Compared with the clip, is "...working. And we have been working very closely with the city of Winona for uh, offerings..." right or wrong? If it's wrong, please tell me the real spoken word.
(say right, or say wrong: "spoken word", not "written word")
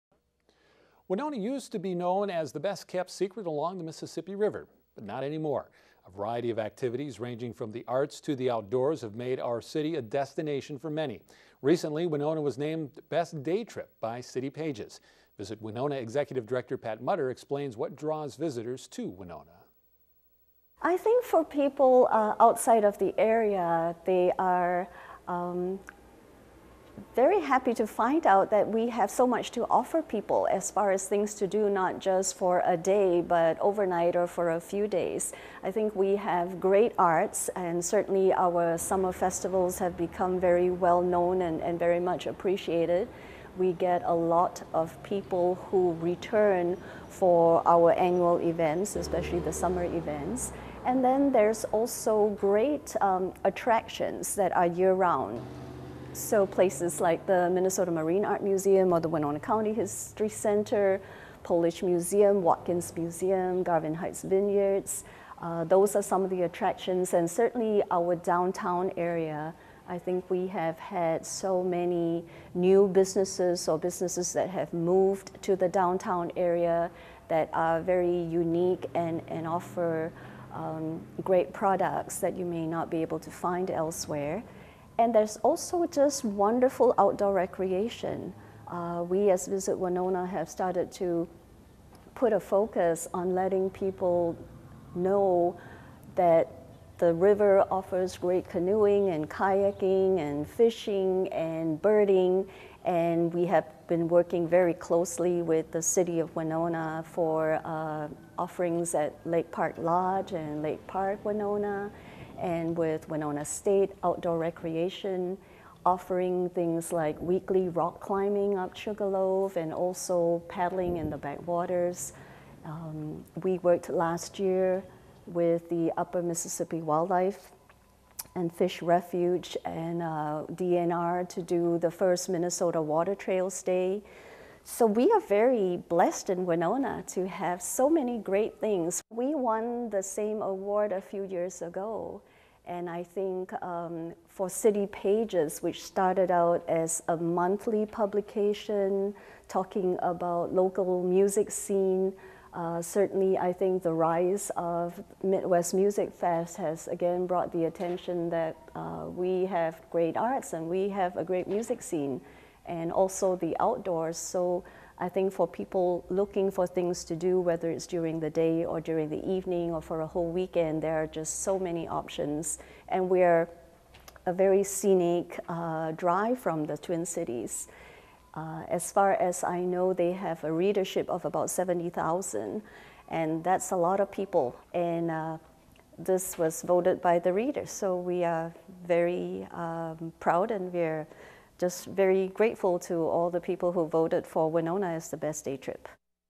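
wrong: "birding", not "working".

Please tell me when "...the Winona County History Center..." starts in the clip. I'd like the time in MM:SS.
00:58.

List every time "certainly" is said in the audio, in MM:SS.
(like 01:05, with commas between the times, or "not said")
00:37, 01:07, 02:32.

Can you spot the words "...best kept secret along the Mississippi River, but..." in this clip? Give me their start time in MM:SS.
00:02.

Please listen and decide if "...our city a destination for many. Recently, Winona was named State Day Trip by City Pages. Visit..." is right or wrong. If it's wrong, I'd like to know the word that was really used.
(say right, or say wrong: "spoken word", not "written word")
wrong: "Best", not "State".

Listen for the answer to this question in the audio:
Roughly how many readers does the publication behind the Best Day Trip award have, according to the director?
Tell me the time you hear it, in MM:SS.
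03:01.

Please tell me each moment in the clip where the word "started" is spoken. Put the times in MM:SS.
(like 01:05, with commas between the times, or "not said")
01:30, 02:25.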